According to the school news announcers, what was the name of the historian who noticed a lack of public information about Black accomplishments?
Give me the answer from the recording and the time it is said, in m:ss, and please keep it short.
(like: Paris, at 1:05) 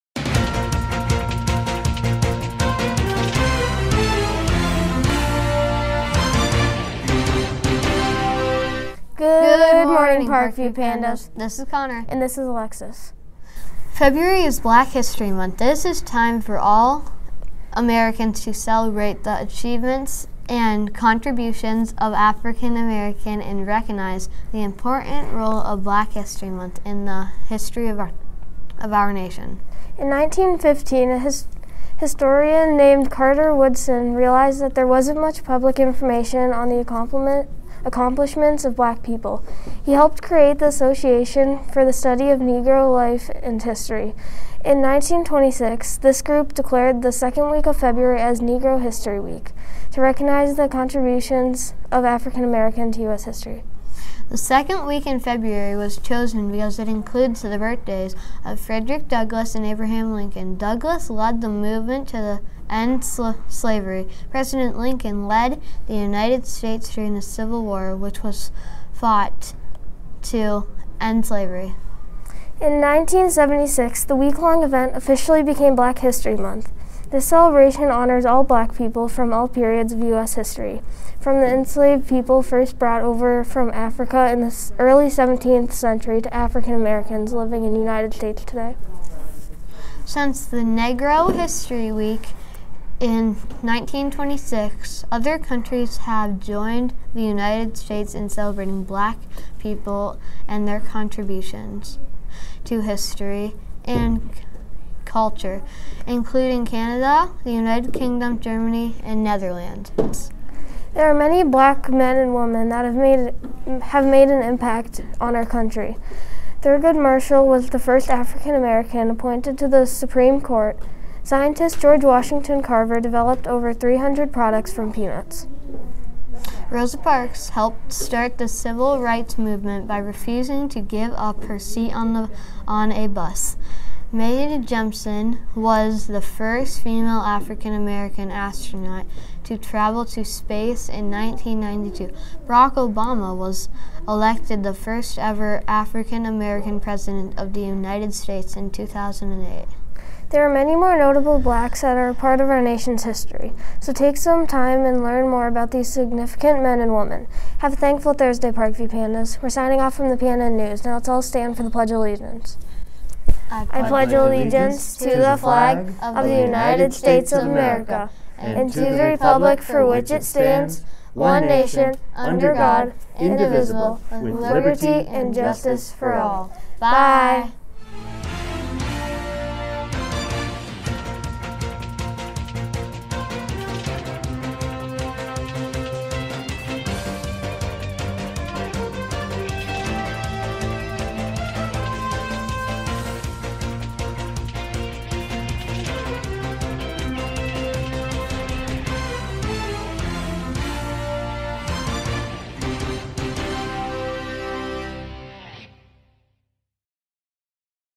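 Carter Woodson, at 0:33.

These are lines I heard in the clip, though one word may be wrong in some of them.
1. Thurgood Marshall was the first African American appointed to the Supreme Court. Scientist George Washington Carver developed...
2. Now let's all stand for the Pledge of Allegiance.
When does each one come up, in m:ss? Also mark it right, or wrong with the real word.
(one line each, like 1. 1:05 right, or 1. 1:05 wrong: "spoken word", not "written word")
1. 1:56 right
2. 2:40 right.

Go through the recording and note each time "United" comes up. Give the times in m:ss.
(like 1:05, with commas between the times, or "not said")
1:05, 1:27, 1:37, 1:47, 2:27, 2:46.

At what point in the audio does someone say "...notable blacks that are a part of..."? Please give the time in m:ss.
2:30.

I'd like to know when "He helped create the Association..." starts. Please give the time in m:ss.
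0:39.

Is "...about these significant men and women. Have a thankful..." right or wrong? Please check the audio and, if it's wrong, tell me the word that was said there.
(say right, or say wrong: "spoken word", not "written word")
right.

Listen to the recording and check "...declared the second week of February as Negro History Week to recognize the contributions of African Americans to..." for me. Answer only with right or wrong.
right.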